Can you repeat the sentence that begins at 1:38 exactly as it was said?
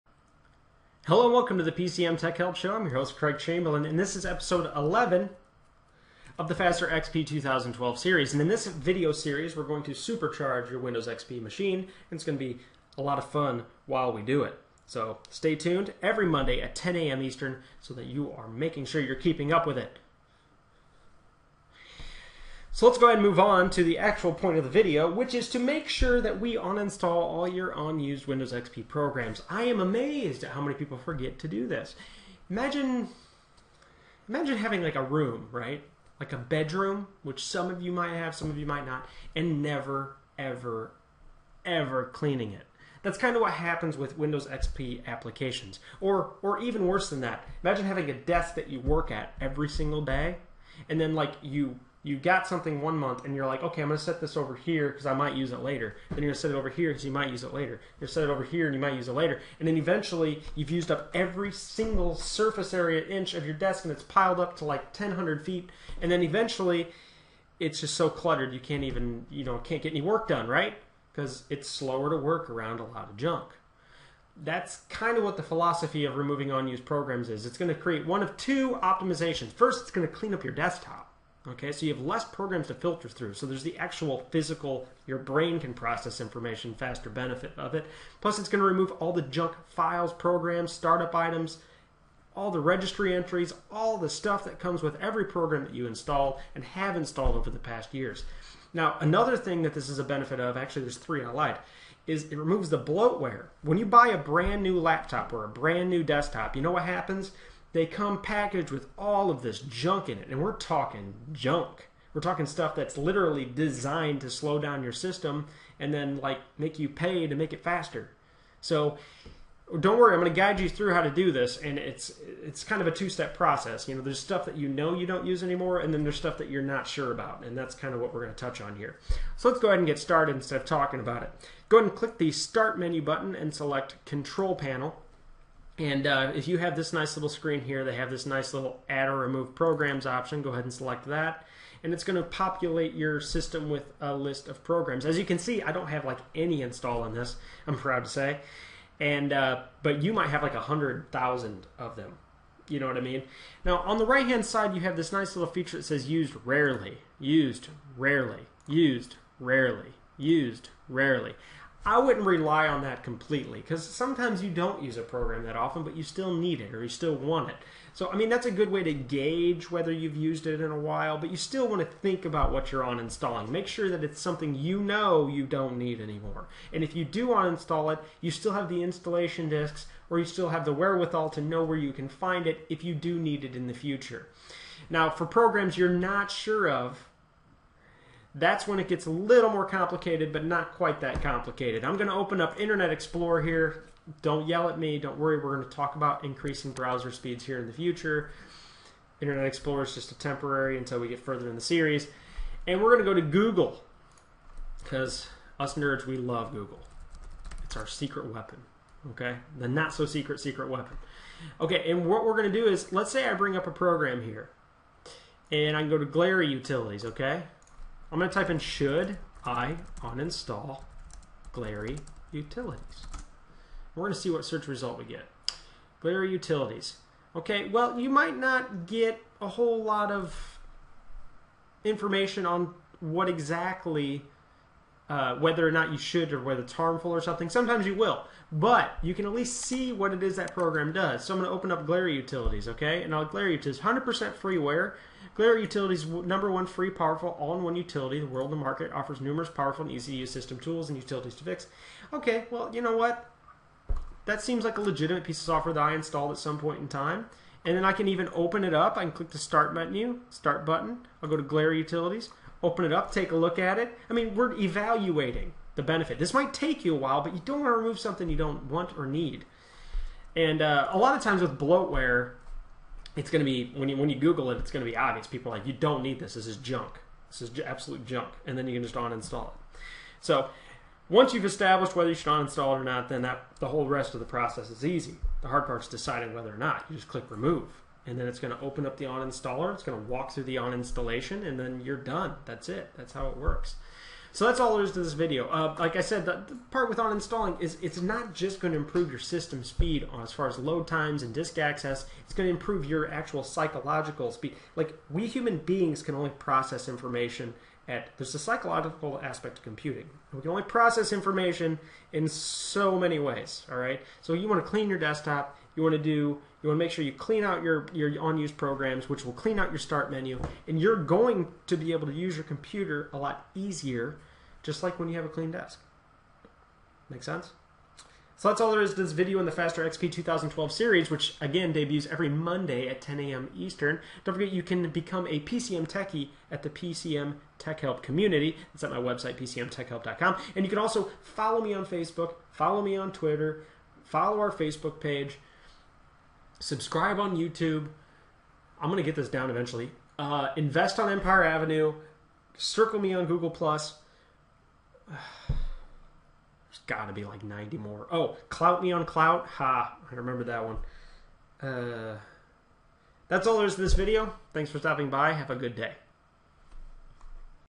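Now, another thing that this is a benefit of, actually, there's three I lied, is it removes the bloatware.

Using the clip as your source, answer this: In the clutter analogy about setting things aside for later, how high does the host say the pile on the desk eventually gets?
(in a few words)
1,000 feet.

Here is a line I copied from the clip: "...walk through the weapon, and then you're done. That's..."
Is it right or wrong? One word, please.
wrong.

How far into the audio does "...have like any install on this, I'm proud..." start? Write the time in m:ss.
2:25.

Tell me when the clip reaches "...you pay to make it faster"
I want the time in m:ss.
1:56.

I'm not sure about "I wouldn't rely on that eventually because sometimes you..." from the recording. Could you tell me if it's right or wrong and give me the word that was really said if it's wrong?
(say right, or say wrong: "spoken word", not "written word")
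wrong: "completely", not "eventually".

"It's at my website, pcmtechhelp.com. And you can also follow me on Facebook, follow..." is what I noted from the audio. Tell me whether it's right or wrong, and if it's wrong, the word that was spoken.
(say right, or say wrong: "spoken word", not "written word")
right.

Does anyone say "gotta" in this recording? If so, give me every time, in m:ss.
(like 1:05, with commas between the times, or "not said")
5:56.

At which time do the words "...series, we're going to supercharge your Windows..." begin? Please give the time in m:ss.
0:09.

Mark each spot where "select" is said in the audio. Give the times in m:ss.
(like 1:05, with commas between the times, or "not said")
2:13, 2:20.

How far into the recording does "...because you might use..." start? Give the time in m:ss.
0:56.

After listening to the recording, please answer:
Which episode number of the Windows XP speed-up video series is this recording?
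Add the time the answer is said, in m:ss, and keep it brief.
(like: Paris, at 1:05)
11, at 0:04.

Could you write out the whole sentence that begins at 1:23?
So there's the actual physical, your brain can process information faster benefit of it.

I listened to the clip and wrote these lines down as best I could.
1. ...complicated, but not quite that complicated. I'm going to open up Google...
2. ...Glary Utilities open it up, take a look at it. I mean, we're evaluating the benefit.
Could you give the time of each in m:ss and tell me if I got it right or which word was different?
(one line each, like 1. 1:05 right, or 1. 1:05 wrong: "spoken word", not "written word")
1. 3:09 wrong: "Internet", not "Google"
2. 4:21 right.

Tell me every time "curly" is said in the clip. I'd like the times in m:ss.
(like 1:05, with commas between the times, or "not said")
not said.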